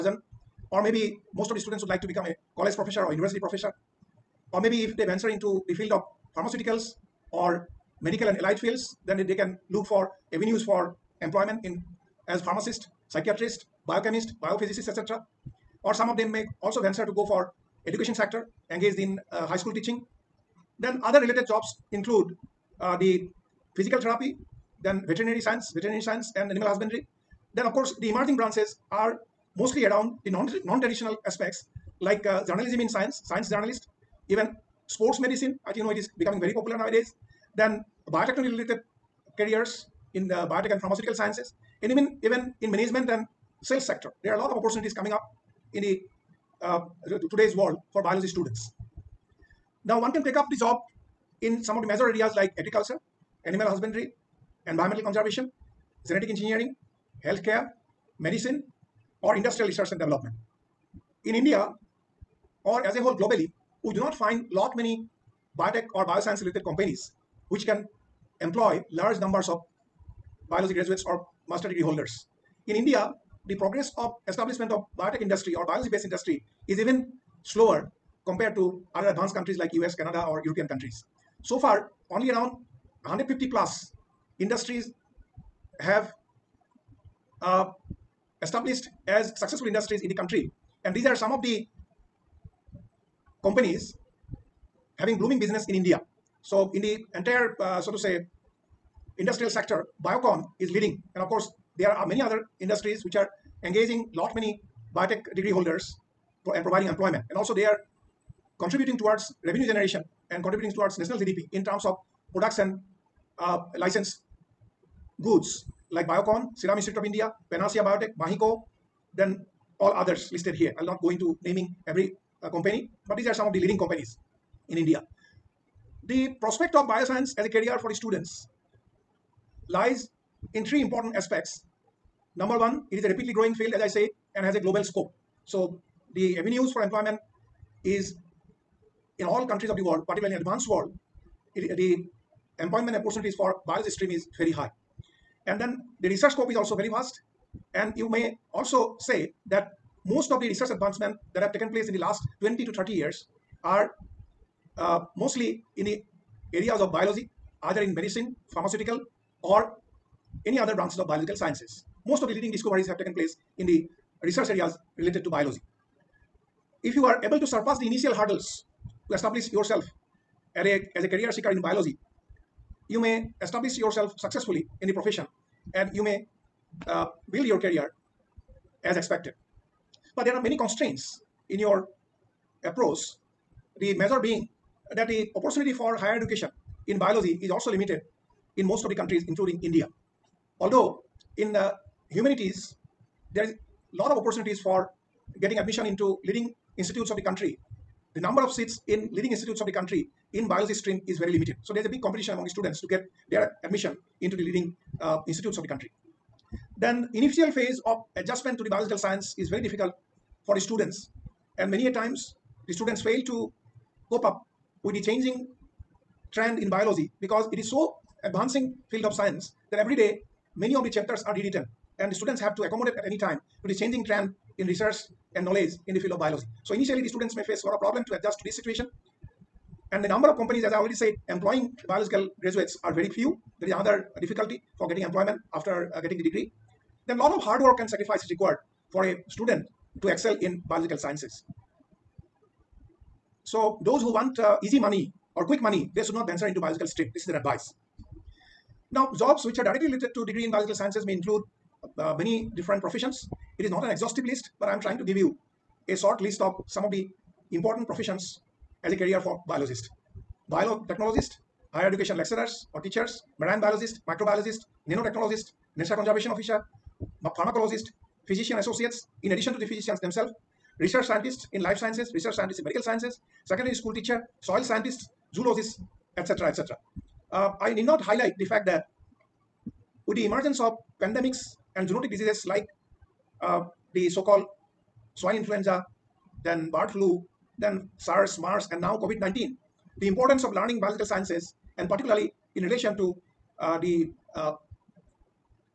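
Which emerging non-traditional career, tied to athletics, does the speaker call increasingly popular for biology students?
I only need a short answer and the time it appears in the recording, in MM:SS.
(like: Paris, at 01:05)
Sports medicine, at 00:34.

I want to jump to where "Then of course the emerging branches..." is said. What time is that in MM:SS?
00:27.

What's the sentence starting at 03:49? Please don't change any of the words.
And the number of companies, as I already said, employing biological graduates are very few.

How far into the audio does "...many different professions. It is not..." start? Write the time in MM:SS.
04:12.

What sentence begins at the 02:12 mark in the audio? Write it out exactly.
Number one, it is a rapidly growing field, as I said, and has a global scope.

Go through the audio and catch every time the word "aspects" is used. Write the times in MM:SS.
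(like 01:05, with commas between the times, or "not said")
00:31, 02:11.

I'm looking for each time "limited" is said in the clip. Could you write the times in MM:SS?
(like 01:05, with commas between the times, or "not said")
03:07, 03:21.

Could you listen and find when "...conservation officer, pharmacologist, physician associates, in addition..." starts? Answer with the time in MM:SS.
04:25.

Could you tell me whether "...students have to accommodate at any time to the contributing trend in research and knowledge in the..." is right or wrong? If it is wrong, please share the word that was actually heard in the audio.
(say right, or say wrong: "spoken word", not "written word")
wrong: "changing", not "contributing".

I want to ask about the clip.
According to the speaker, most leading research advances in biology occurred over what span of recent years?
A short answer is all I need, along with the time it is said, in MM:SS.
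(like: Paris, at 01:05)
20 to 30 years, at 02:32.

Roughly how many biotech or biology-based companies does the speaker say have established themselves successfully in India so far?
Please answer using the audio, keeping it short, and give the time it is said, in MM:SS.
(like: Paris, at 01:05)
150 plus, at 01:23.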